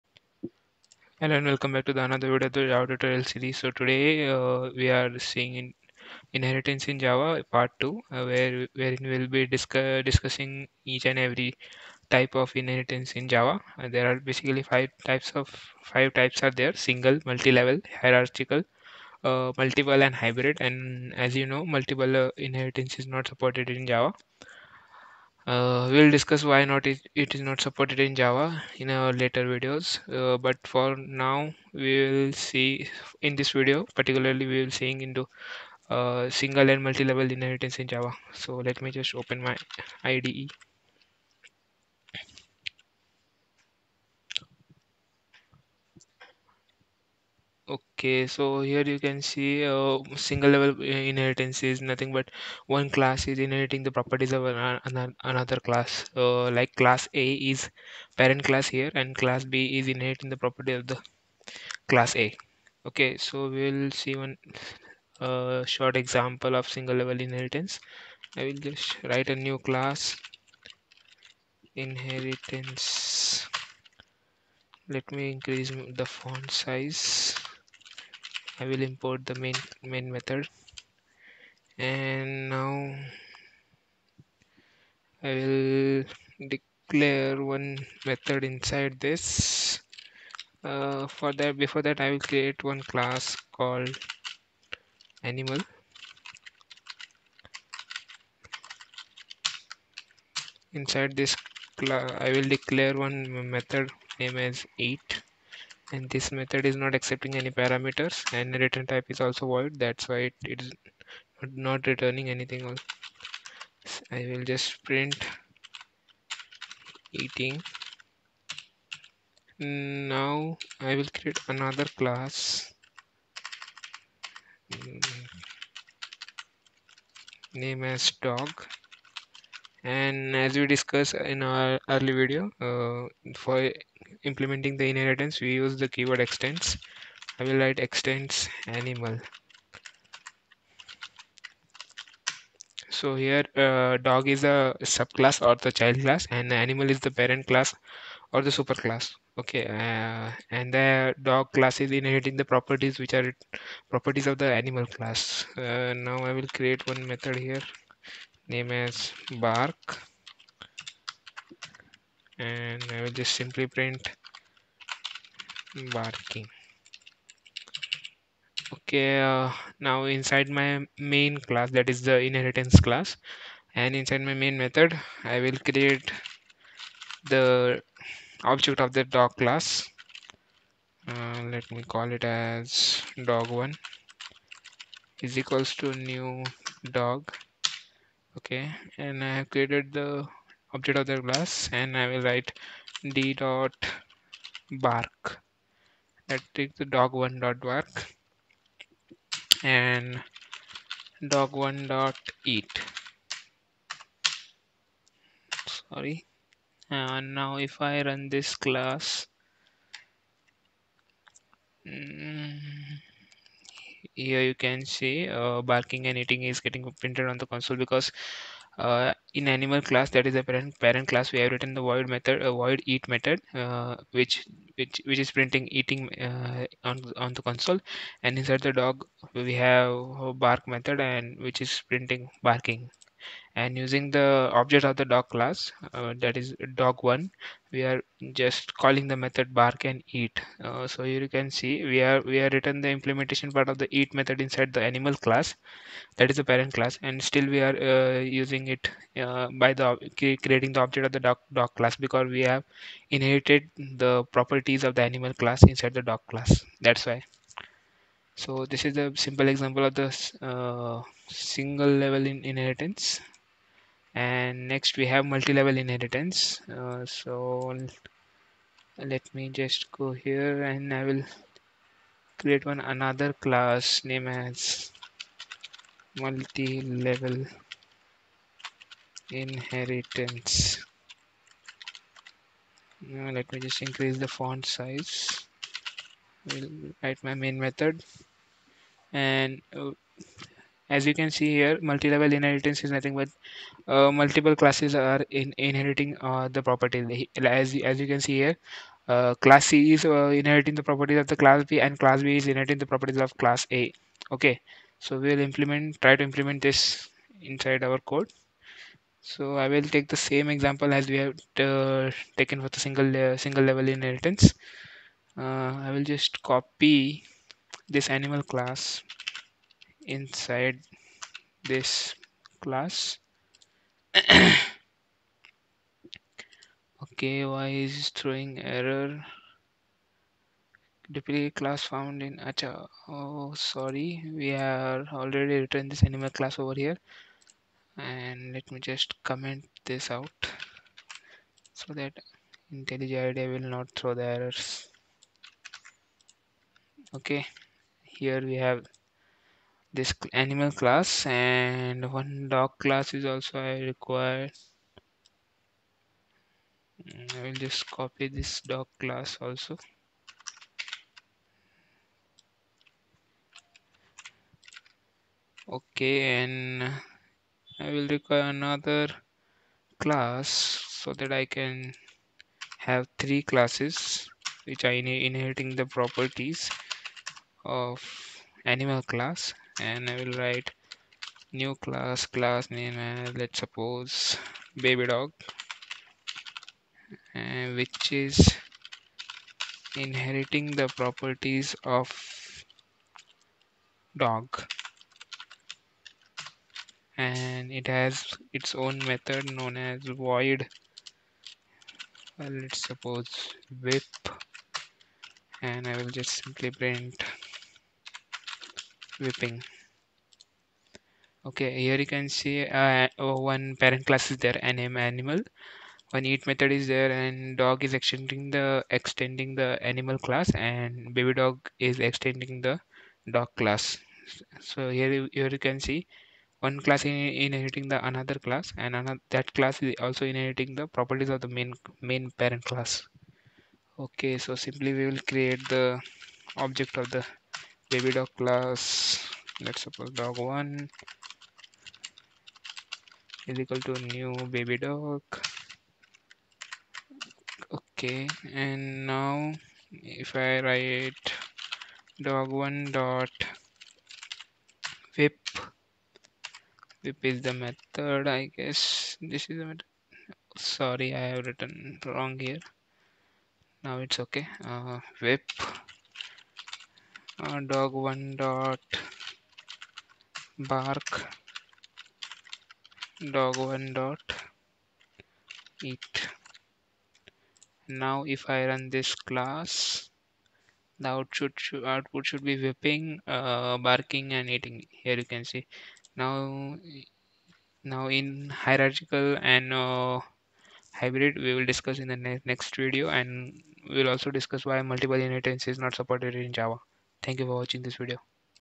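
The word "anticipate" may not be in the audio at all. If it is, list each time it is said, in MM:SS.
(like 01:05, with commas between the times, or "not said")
not said.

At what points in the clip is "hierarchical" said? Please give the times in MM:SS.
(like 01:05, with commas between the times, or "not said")
00:18, 08:08.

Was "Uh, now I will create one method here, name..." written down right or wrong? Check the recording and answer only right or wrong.
right.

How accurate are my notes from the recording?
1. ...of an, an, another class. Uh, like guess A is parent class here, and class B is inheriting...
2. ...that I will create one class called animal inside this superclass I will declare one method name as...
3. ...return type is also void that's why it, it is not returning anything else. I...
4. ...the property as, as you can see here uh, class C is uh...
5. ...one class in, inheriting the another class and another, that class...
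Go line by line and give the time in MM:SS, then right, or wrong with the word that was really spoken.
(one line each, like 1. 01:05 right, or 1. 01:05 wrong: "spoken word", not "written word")
1. 00:54 wrong: "class", not "guess"
2. 01:31 wrong: "class", not "superclass"
3. 01:48 right
4. 04:56 right
5. 07:06 right.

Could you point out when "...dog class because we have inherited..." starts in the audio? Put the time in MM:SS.
04:11.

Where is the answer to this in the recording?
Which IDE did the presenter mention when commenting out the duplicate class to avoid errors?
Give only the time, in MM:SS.
05:42.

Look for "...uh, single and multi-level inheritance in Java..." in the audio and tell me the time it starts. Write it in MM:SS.
00:35.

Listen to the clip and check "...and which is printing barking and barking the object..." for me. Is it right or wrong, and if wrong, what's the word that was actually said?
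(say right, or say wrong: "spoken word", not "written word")
wrong: "using", not "barking".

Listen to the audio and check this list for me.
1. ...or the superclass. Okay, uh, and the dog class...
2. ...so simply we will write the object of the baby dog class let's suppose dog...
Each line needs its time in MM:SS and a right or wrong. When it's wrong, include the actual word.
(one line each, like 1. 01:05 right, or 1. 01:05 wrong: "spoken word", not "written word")
1. 02:28 right
2. 07:14 wrong: "create", not "write".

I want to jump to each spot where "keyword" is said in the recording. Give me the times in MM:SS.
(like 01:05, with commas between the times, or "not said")
02:15.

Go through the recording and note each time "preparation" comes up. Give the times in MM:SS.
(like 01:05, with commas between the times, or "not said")
not said.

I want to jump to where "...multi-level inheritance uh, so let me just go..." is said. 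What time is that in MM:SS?
04:25.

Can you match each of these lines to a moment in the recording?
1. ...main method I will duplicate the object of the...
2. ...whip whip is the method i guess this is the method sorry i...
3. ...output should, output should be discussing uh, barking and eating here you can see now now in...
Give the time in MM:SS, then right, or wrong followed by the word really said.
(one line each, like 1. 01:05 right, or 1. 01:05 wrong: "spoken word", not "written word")
1. 02:54 wrong: "create", not "duplicate"
2. 07:35 right
3. 08:01 wrong: "whipping", not "discussing".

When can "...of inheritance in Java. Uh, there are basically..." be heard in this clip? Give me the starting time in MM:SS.
00:12.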